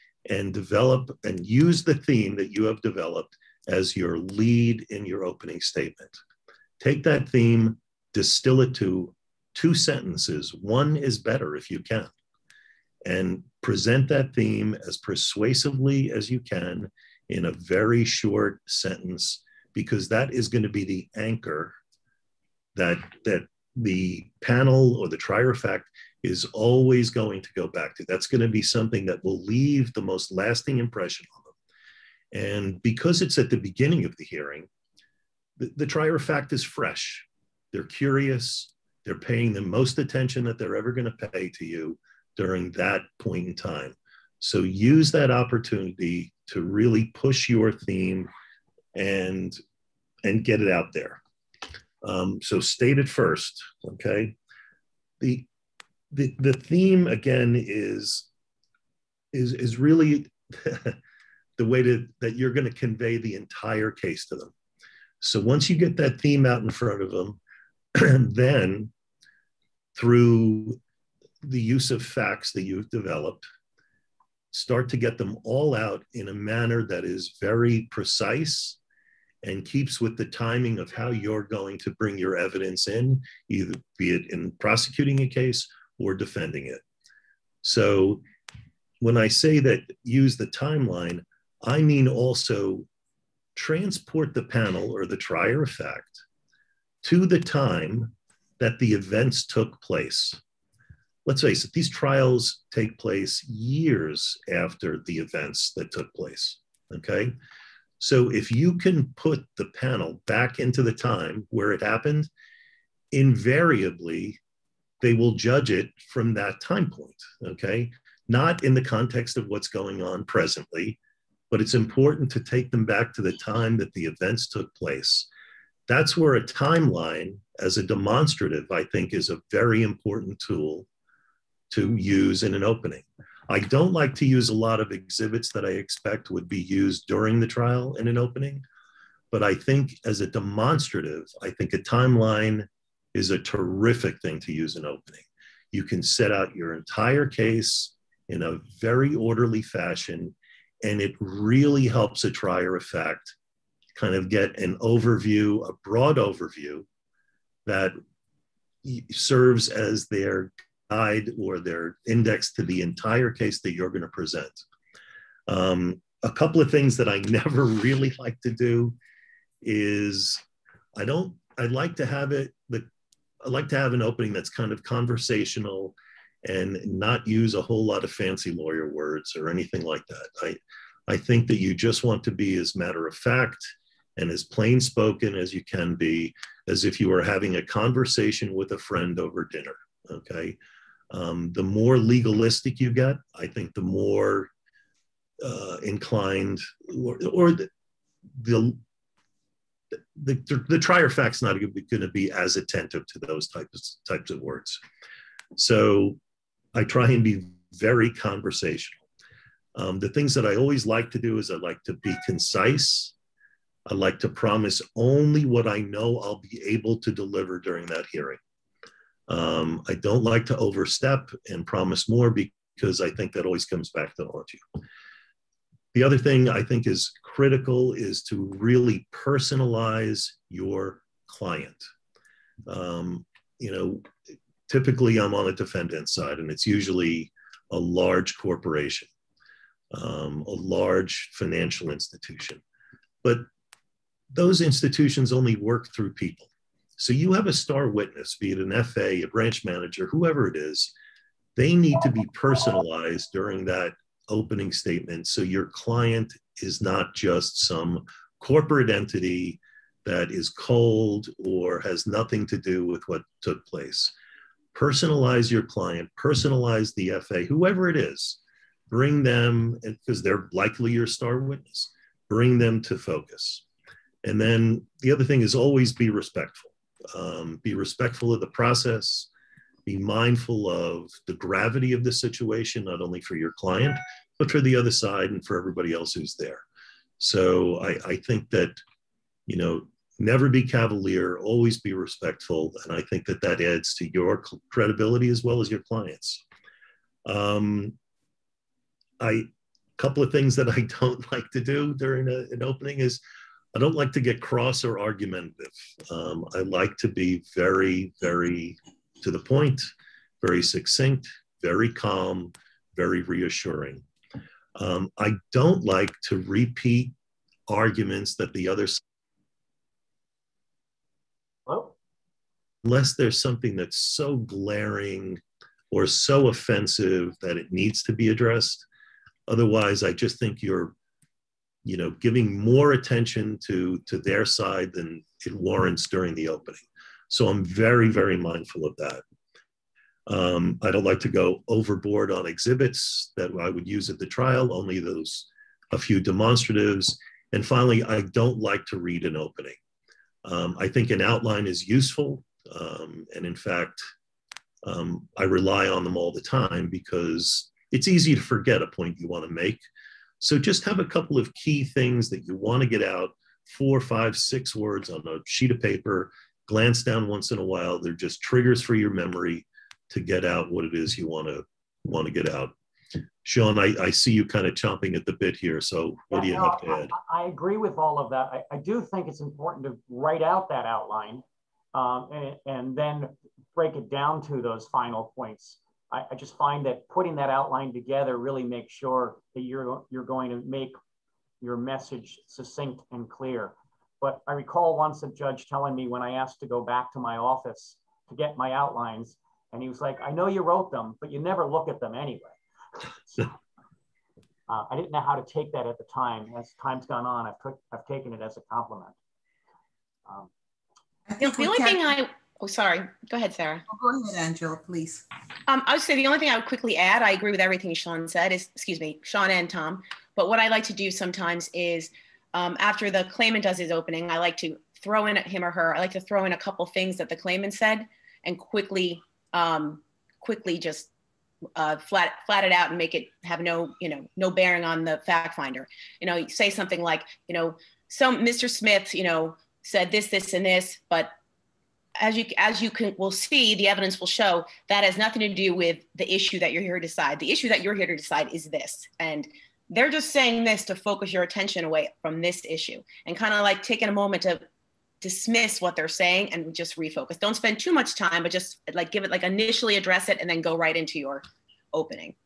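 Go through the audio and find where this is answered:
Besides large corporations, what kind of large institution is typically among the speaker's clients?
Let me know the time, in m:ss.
4:00.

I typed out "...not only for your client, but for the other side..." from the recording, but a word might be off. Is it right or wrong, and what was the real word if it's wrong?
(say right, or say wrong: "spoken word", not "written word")
right.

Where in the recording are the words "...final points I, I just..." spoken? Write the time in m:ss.
6:24.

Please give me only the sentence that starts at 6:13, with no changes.
Sean, I, I see you kind of chomping at the bit here.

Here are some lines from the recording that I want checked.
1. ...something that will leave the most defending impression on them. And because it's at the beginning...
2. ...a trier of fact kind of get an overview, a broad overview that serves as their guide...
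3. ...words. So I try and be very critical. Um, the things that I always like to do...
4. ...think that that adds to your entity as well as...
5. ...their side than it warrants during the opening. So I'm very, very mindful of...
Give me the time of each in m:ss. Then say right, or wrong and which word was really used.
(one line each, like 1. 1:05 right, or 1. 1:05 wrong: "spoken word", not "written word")
1. 0:28 wrong: "lasting", not "defending"
2. 2:32 right
3. 3:24 wrong: "conversational", not "critical"
4. 4:53 wrong: "credibility", not "entity"
5. 5:34 right.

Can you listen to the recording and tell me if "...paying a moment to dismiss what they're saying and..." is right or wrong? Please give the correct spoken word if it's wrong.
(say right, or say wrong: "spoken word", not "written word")
wrong: "taking", not "paying".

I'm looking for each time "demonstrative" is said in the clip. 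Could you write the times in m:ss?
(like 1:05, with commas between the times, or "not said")
2:07, 2:20, 5:46.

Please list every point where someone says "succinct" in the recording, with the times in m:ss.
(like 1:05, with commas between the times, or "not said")
5:10, 6:32.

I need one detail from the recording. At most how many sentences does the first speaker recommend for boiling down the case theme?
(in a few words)
2.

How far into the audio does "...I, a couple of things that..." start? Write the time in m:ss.
4:59.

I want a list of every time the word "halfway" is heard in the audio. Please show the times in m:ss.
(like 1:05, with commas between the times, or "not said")
not said.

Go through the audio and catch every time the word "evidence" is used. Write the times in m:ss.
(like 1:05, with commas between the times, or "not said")
1:22, 7:23.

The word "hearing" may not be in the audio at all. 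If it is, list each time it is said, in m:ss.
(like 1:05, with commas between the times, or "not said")
0:34, 3:38.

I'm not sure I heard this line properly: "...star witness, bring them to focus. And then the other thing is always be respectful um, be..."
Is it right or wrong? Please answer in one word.
right.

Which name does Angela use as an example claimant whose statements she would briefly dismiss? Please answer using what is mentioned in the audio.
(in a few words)
Mr. Smith.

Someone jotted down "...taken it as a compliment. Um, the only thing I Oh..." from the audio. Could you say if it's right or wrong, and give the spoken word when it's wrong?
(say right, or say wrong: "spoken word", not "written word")
right.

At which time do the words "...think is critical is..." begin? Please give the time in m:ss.
3:46.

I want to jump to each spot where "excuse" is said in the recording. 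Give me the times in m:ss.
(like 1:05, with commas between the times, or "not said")
6:58.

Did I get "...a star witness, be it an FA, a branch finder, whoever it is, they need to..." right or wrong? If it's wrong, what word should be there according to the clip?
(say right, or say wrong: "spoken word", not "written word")
wrong: "manager", not "finder".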